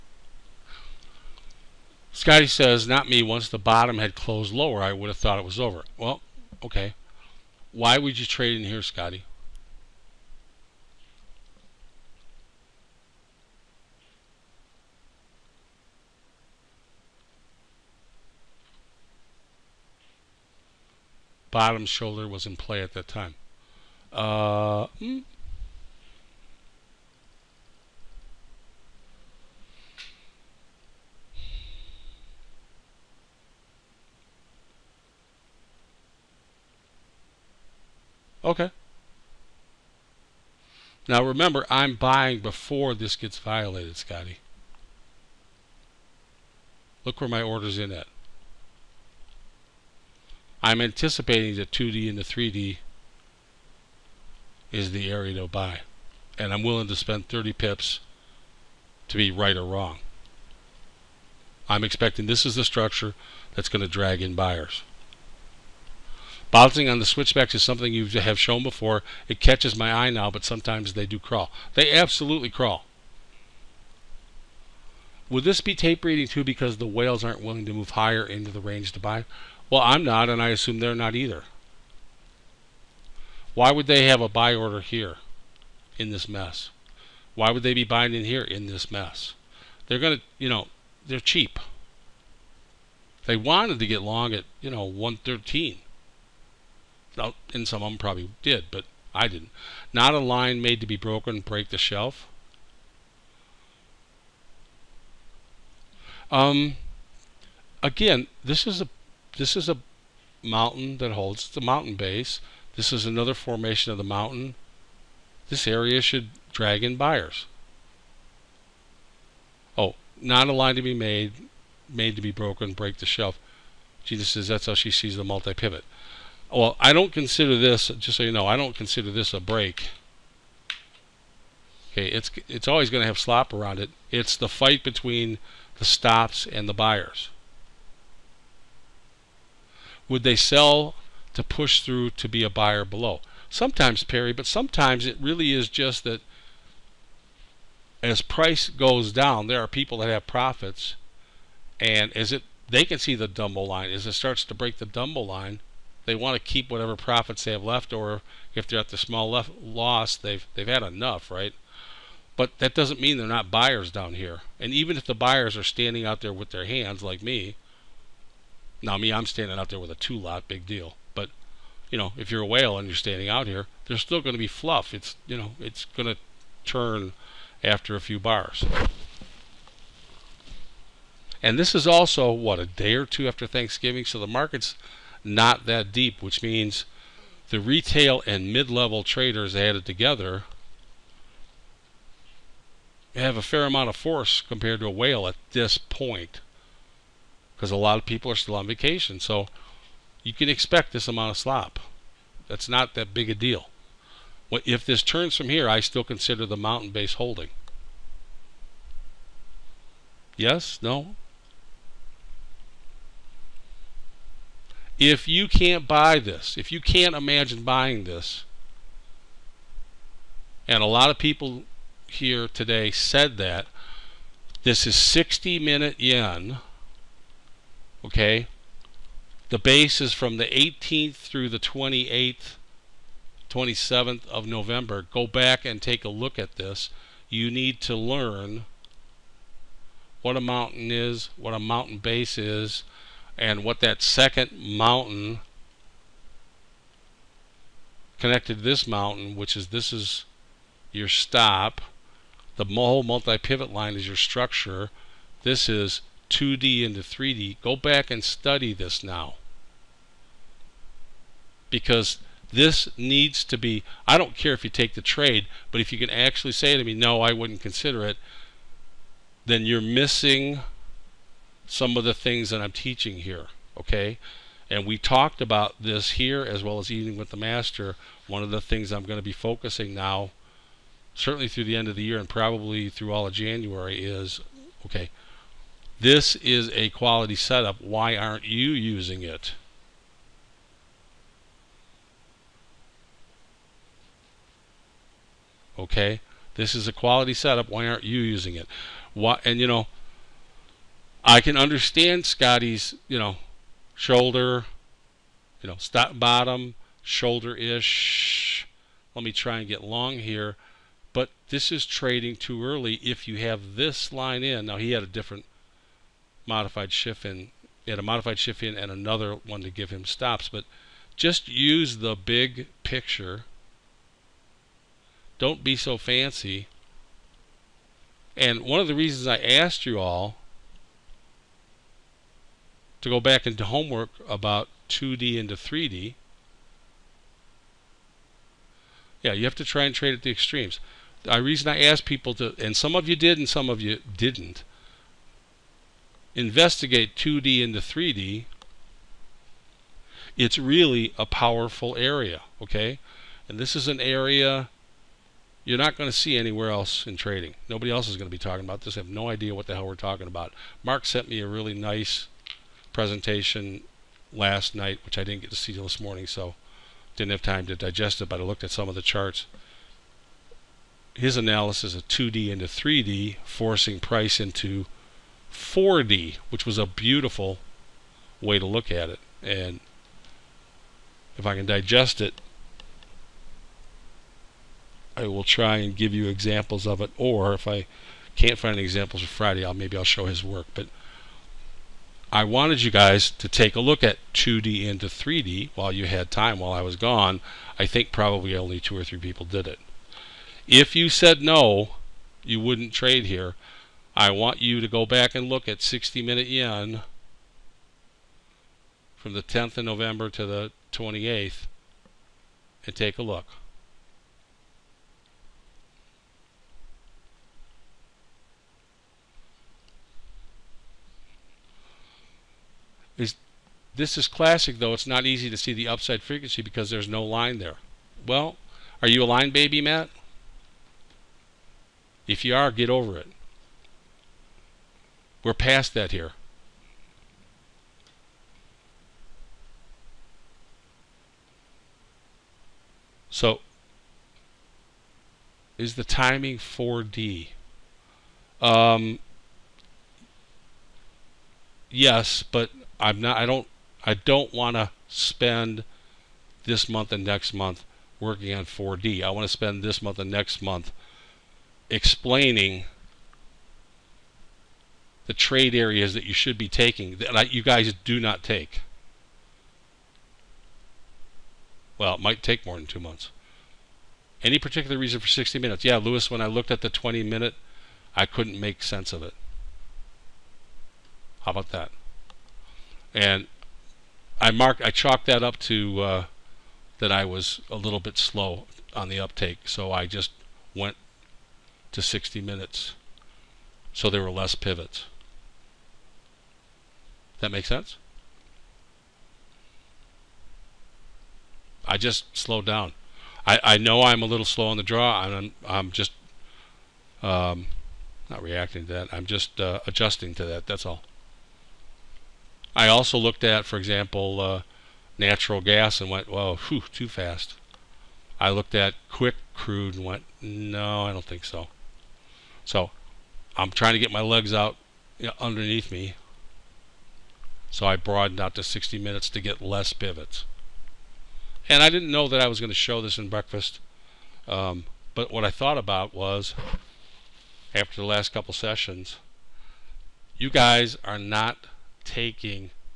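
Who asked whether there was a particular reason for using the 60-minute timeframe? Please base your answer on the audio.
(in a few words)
Lewis.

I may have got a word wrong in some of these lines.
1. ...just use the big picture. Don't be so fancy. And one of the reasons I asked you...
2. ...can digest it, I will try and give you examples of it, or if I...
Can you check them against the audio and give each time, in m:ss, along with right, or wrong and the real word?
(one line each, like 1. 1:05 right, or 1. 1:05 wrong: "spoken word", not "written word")
1. 5:21 right
2. 6:21 right.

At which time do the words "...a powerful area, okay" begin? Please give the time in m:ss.
5:51.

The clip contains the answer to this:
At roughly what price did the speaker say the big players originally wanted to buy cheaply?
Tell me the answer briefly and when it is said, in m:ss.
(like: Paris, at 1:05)
113, at 1:34.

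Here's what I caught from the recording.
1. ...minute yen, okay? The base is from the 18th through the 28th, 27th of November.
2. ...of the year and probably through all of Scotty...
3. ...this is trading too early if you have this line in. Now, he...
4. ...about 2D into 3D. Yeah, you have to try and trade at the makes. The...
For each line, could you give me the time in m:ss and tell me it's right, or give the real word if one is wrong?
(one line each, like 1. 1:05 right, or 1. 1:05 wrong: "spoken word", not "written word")
1. 3:45 right
2. 4:41 wrong: "January", not "Scotty"
3. 5:11 right
4. 5:34 wrong: "extremes", not "makes".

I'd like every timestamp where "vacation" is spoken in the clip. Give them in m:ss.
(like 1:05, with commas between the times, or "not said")
3:18.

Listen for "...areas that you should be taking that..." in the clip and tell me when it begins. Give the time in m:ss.
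7:45.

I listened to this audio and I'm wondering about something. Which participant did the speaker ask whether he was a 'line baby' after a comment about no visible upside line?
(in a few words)
Matt.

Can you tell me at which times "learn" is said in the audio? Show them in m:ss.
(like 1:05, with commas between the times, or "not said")
3:57.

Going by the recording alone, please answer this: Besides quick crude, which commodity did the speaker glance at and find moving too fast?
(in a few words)
natural gas.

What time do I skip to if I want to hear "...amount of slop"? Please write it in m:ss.
3:21.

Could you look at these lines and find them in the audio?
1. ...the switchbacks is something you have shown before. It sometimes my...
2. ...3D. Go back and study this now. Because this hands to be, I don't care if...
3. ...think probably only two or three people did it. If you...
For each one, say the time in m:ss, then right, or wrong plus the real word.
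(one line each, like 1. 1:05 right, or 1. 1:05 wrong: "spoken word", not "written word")
1. 1:06 wrong: "catches", not "sometimes"
2. 4:17 wrong: "needs", not "hands"
3. 6:37 right.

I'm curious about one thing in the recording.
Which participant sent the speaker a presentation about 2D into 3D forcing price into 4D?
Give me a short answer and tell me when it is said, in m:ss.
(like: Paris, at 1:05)
Mark, at 6:00.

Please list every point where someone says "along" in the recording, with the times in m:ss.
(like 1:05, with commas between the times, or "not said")
not said.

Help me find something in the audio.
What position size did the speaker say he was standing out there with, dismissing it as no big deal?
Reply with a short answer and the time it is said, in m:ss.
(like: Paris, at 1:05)
two lot, at 2:49.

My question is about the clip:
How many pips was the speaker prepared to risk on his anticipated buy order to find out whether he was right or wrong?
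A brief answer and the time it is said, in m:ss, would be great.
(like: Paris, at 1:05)
30, at 0:57.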